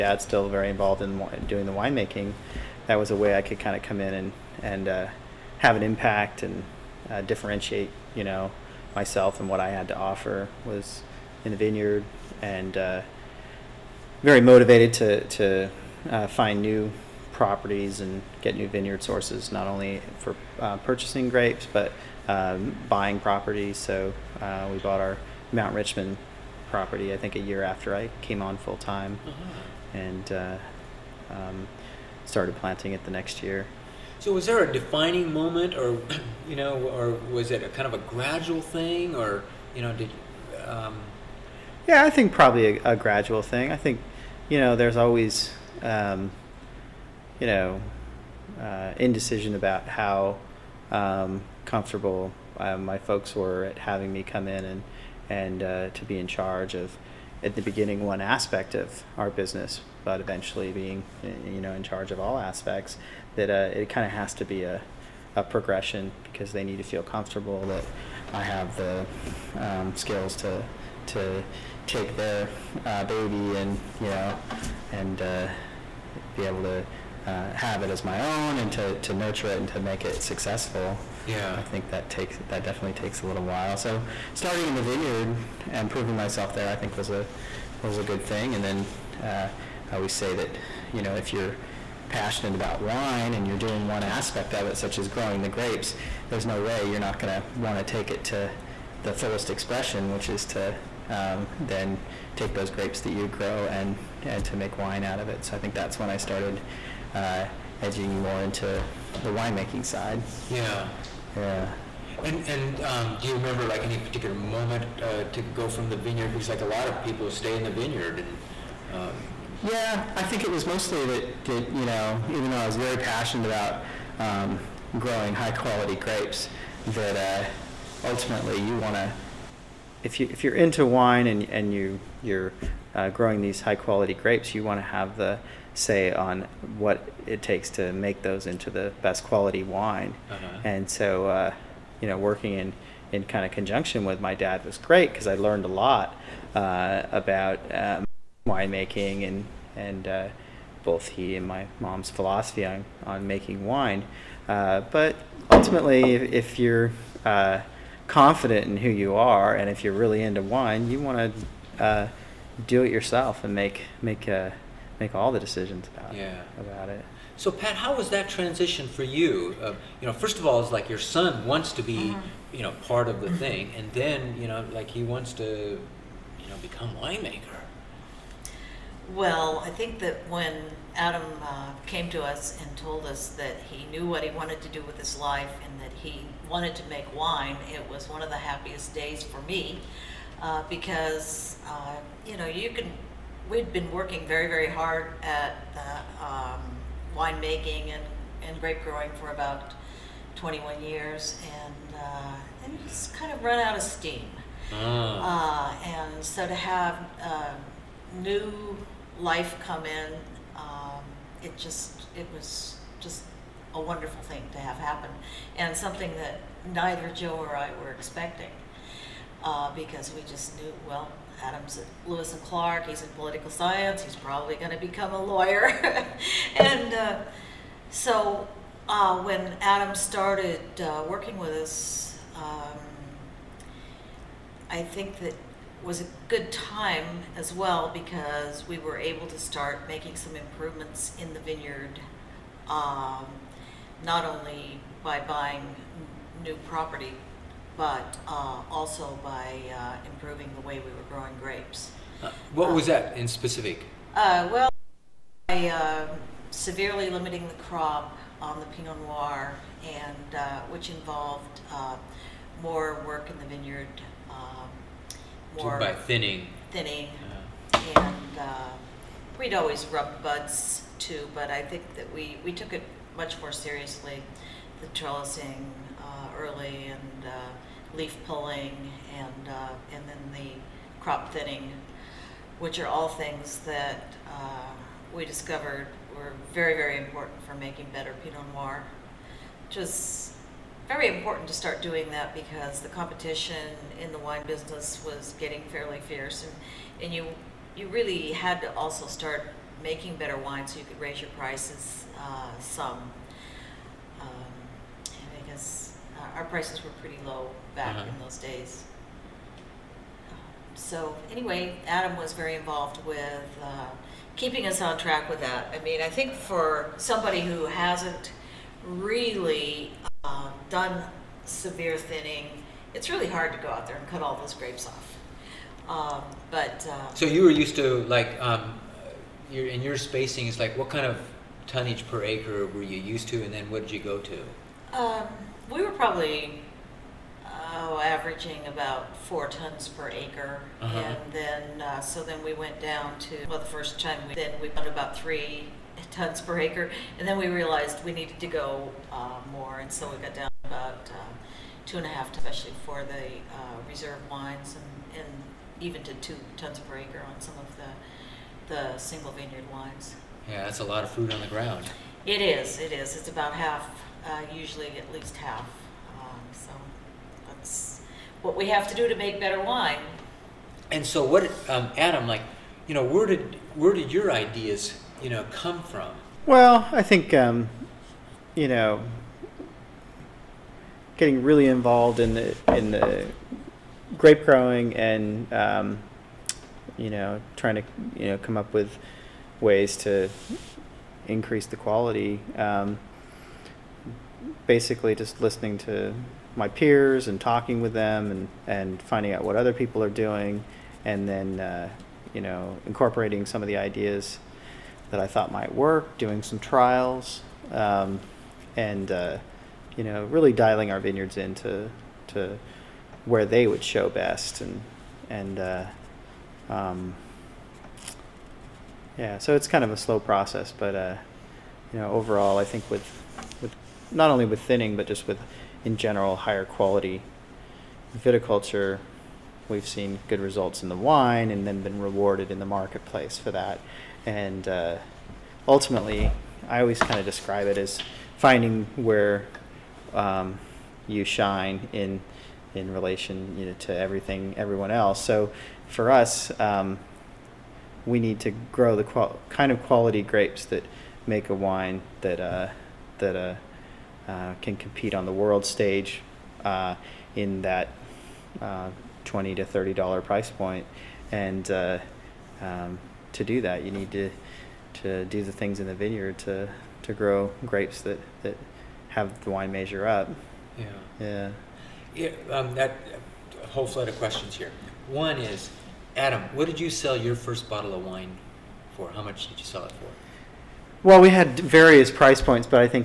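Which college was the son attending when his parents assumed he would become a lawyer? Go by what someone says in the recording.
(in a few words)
Lewis and Clark.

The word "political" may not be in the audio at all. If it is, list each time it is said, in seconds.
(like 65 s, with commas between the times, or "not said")
223 s.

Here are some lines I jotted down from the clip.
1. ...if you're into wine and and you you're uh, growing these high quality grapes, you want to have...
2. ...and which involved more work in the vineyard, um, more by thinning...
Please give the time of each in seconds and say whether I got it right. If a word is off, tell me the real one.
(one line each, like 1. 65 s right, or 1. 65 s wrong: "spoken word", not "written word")
1. 130 s right
2. 259 s right.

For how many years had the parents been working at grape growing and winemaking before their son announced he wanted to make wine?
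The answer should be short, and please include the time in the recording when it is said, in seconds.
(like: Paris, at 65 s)
21, at 200 s.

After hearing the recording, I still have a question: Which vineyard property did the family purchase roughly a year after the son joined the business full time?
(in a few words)
Mount Richmond.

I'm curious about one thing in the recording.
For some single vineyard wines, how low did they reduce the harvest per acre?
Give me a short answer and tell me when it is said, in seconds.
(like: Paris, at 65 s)
2 tons, at 356 s.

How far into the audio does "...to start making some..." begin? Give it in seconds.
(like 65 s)
239 s.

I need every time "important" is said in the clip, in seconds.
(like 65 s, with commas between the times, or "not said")
286 s, 291 s.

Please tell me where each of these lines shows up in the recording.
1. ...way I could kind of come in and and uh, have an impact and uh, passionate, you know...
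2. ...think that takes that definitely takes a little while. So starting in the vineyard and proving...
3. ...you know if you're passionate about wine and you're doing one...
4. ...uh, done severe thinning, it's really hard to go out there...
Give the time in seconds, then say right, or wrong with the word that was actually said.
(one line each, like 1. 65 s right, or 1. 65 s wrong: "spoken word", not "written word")
1. 3 s wrong: "differentiate", not "passionate"
2. 81 s right
3. 90 s right
4. 320 s right.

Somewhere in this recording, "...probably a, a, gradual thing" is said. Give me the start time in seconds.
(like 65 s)
42 s.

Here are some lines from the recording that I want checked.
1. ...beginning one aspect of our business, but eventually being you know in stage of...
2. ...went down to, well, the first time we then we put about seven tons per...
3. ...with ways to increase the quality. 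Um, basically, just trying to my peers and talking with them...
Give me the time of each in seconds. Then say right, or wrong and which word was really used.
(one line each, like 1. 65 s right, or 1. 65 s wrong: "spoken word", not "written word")
1. 57 s wrong: "charge", not "stage"
2. 342 s wrong: "three", not "seven"
3. 388 s wrong: "listening", not "trying".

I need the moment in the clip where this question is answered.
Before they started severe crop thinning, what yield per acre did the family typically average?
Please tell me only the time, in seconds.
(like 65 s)
339 s.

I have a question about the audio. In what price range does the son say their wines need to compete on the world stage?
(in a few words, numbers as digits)
$20 to $30.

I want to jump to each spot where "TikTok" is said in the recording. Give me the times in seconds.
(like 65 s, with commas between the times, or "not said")
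not said.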